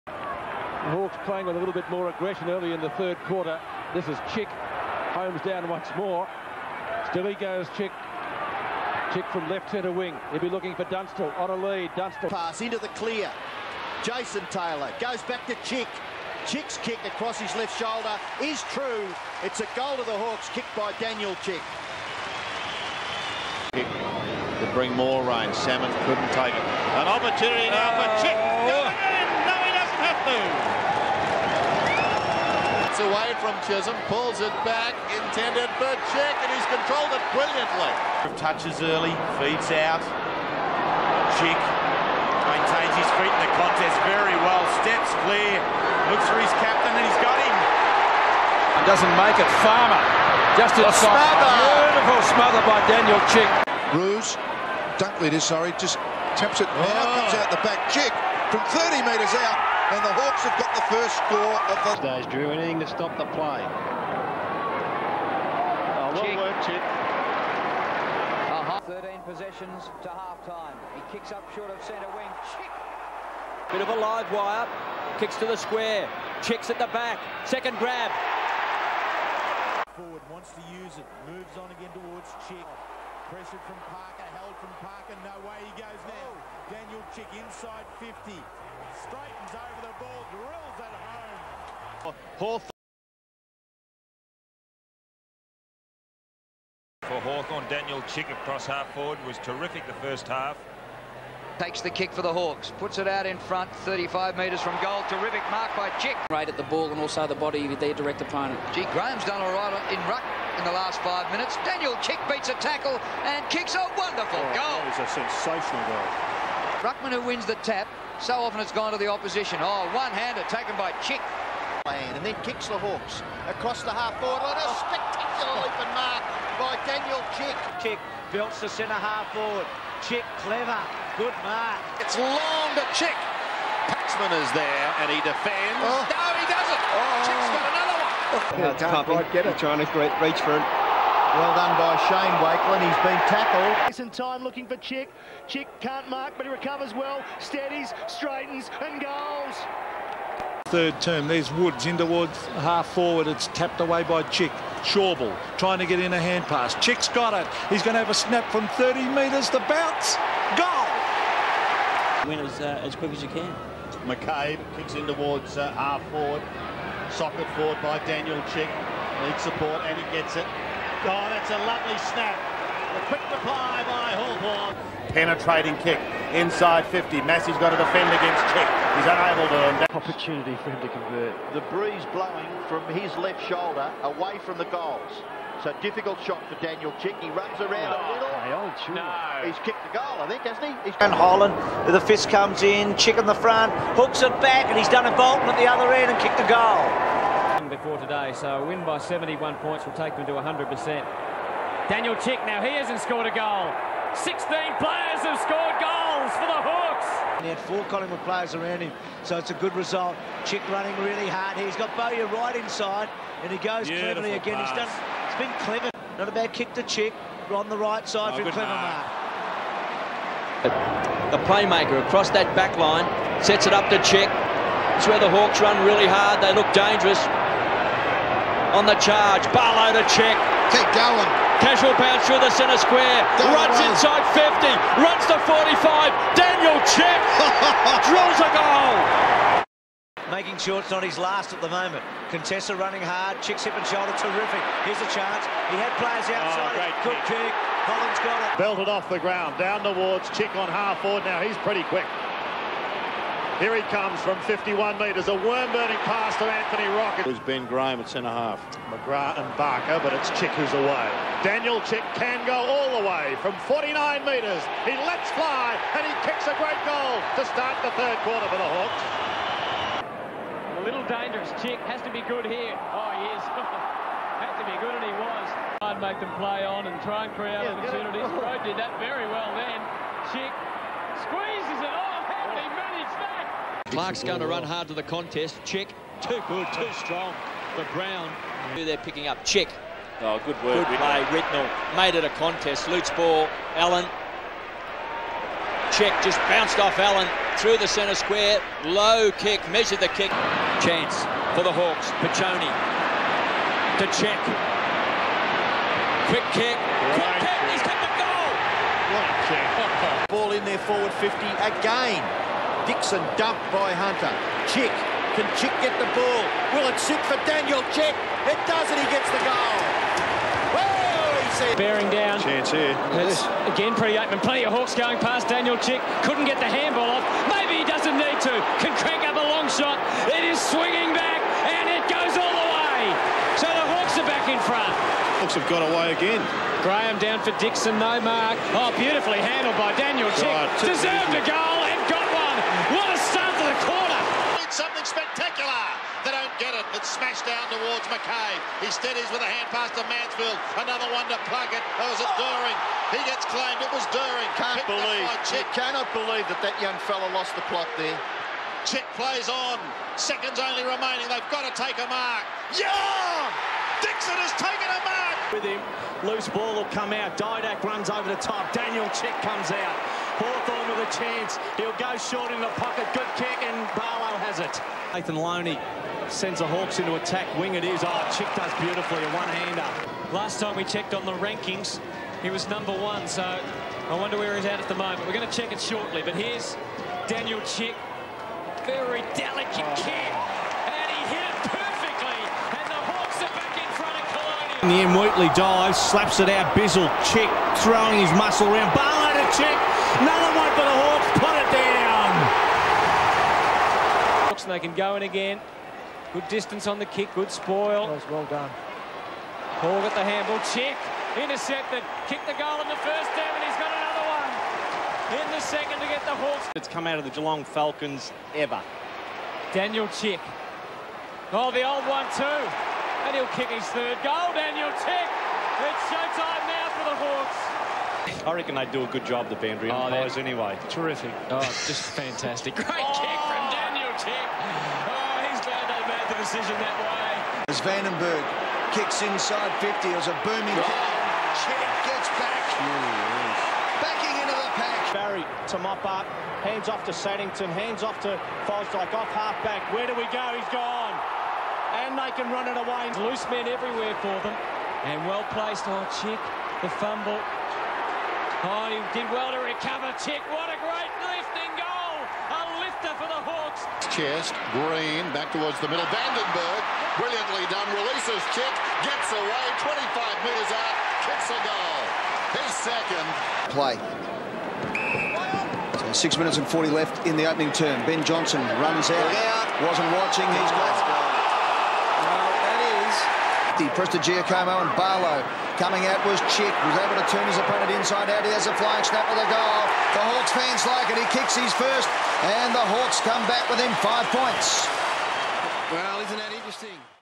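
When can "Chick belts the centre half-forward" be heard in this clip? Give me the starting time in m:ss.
2:07.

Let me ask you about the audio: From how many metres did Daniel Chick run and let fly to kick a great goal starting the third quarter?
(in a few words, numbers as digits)
49.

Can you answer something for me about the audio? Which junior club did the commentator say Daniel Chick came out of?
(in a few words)
Geelong Falcons.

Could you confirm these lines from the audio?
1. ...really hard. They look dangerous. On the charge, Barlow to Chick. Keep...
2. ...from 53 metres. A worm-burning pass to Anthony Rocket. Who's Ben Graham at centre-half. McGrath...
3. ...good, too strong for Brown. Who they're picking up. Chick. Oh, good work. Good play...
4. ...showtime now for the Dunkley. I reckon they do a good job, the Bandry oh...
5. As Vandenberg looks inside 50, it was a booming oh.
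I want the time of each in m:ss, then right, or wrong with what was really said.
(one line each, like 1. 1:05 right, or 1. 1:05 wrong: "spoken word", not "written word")
1. 3:45 right
2. 4:14 wrong: "51", not "53"
3. 4:46 right
4. 7:06 wrong: "Hawks", not "Dunkley"
5. 7:17 wrong: "kicks", not "looks".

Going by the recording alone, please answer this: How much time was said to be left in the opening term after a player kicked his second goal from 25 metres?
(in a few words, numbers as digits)
6 minutes 40.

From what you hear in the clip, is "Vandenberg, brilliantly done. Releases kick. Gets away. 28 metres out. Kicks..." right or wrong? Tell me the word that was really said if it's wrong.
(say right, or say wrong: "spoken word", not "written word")
wrong: "25", not "28".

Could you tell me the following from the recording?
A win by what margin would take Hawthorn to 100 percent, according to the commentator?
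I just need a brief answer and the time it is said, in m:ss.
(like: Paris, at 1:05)
71 points, at 3:18.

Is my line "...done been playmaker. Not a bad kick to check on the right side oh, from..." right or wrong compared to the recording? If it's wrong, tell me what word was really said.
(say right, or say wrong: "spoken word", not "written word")
wrong: "clever", not "playmaker".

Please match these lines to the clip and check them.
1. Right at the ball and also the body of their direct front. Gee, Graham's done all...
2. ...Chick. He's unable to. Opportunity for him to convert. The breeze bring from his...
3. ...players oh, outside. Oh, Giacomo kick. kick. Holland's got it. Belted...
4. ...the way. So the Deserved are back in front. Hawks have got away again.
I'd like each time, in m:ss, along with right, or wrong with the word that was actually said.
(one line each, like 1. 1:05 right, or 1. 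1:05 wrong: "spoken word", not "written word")
1. 1:46 wrong: "opponent", not "front"
2. 2:58 wrong: "blowing", not "bring"
3. 4:05 wrong: "Good", not "Giacomo"
4. 5:32 wrong: "Hawks", not "Deserved".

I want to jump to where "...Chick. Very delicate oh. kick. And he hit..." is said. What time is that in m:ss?
6:27.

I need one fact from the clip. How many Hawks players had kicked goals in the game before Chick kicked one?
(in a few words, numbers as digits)
16.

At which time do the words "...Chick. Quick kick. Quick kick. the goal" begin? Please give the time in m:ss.
5:04.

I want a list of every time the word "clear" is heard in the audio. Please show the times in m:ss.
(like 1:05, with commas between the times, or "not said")
0:12, 0:45.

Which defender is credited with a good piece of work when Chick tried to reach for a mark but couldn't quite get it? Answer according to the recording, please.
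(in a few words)
Shane Wakelin.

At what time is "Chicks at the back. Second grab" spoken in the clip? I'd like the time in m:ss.
1:16.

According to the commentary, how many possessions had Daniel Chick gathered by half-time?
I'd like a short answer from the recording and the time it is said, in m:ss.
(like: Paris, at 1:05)
13, at 1:08.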